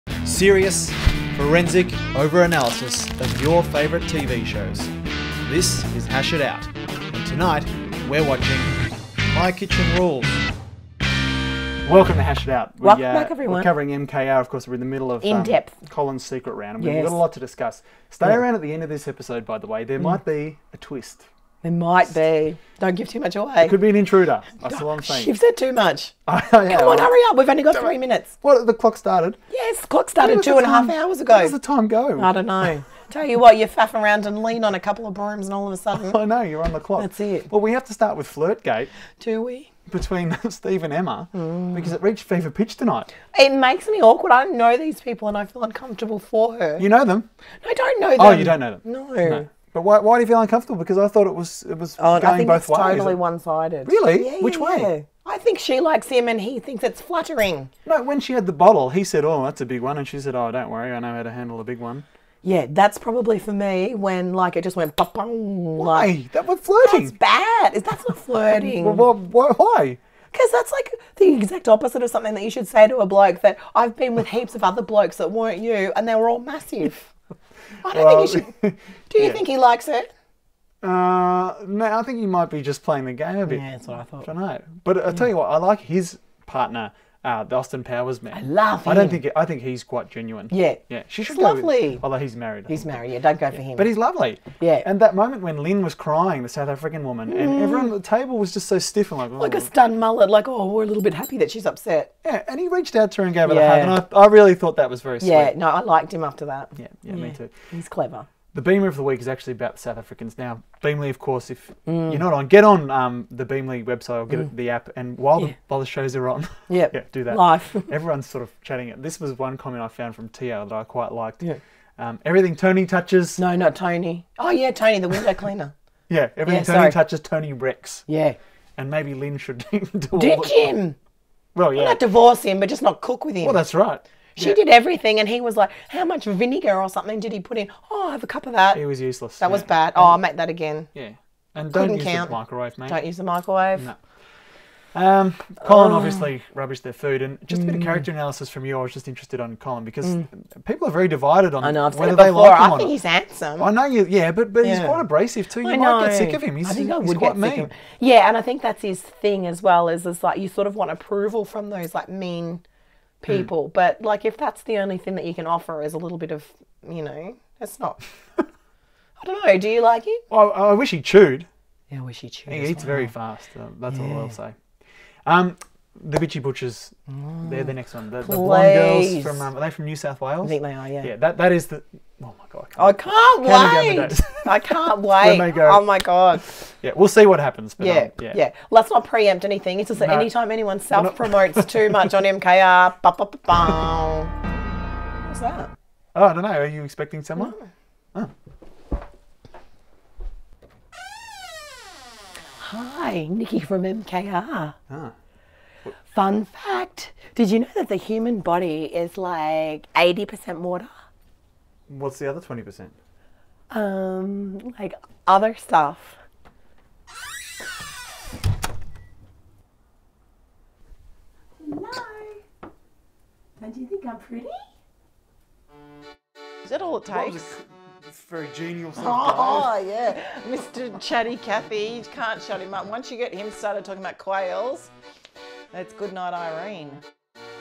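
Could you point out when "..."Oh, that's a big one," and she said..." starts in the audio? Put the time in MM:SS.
00:59.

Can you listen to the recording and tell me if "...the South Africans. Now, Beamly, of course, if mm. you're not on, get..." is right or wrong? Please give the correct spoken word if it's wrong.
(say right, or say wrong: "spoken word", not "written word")
right.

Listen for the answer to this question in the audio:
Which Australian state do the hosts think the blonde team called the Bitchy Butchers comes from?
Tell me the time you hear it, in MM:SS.
02:59.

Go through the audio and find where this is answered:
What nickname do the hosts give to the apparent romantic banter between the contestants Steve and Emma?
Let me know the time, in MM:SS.
00:38.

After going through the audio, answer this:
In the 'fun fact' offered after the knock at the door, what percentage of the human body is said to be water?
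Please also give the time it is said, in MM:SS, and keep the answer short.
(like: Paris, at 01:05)
80%, at 03:29.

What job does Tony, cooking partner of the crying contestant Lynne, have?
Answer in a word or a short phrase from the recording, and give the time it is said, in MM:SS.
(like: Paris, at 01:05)
Window cleaner, at 02:05.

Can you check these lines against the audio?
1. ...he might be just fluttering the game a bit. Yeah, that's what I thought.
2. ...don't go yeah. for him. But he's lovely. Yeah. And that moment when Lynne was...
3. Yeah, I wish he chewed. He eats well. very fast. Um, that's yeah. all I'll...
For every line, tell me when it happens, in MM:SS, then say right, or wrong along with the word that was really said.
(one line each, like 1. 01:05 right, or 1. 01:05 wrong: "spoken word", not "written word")
1. 01:22 wrong: "playing", not "fluttering"
2. 01:33 right
3. 02:51 right.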